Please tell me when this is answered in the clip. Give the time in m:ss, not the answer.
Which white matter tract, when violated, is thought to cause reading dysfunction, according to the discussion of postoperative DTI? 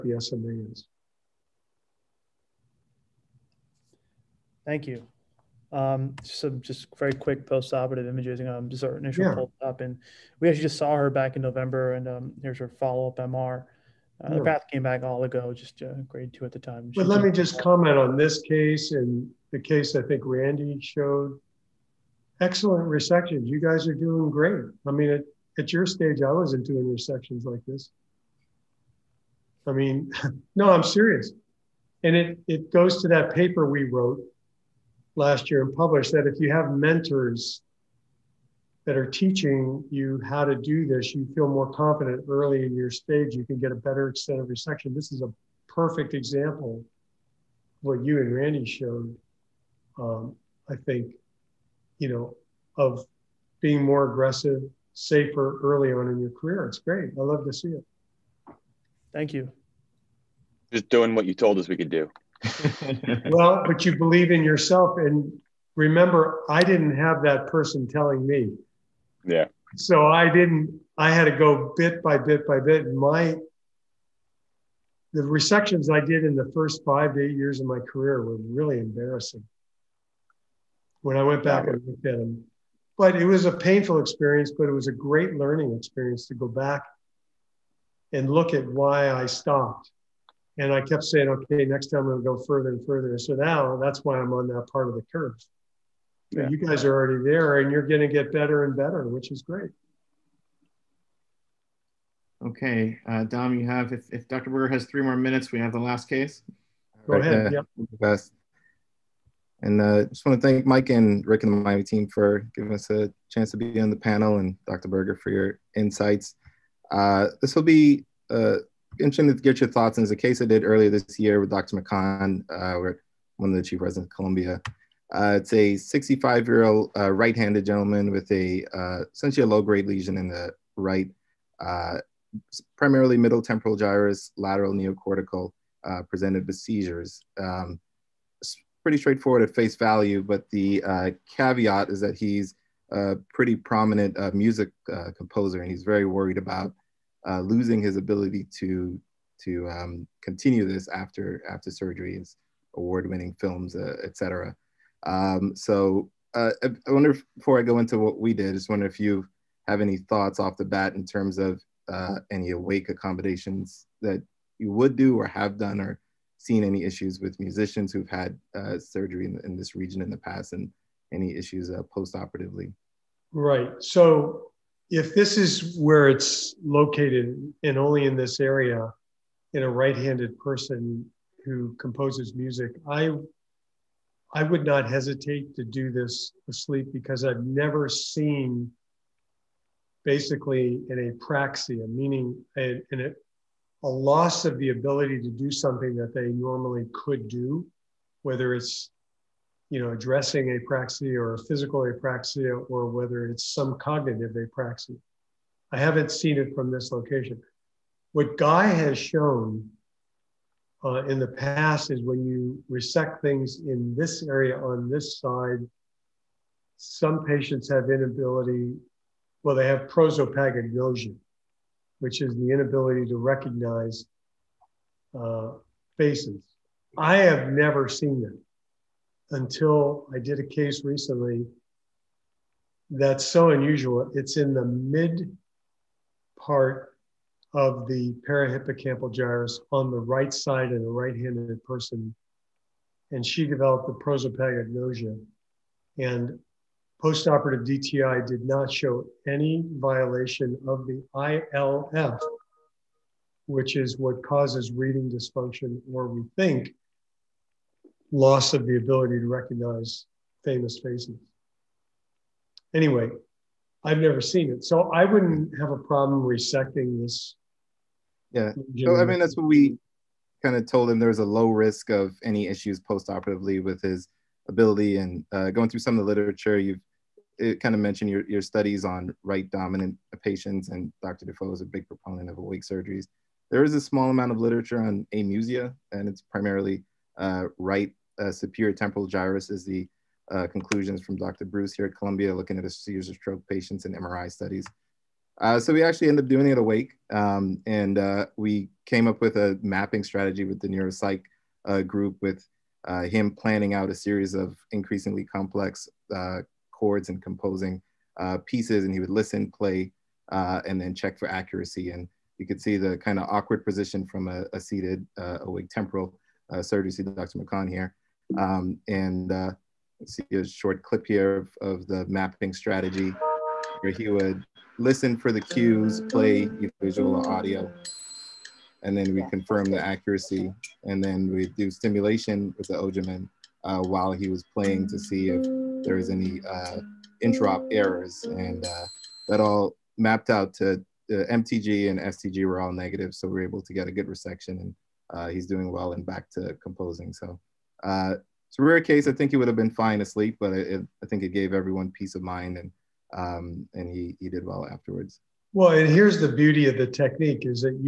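4:11.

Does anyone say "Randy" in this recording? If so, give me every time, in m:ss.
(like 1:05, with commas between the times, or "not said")
0:20, 0:48.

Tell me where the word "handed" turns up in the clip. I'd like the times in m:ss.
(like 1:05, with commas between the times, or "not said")
2:07, 2:59, 4:00.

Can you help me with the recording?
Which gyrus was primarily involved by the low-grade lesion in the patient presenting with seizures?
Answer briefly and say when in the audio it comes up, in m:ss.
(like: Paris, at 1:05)
Middle temporal gyrus, at 2:13.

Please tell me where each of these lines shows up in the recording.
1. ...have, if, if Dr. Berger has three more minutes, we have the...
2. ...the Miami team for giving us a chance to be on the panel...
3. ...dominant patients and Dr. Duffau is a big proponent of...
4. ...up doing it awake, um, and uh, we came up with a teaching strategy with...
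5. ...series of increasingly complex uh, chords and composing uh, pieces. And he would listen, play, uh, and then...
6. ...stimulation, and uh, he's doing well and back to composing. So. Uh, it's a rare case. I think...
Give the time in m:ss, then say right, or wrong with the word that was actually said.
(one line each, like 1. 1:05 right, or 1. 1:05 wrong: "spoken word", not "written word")
1. 1:43 right
2. 1:51 right
3. 4:39 right
4. 4:56 wrong: "mapping", not "teaching"
5. 5:03 right
6. 5:44 wrong: "resection", not "stimulation".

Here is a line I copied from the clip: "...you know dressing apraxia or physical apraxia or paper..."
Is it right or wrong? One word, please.
wrong.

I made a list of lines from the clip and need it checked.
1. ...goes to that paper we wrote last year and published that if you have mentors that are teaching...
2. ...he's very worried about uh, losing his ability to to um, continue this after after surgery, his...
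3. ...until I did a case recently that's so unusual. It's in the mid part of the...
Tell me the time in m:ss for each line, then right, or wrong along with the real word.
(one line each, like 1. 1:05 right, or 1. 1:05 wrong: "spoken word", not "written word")
1. 0:32 right
2. 2:25 right
3. 3:49 right.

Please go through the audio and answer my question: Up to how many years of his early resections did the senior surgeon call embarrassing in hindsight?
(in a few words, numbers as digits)
8.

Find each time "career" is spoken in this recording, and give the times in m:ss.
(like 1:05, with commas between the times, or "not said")
0:56, 1:17.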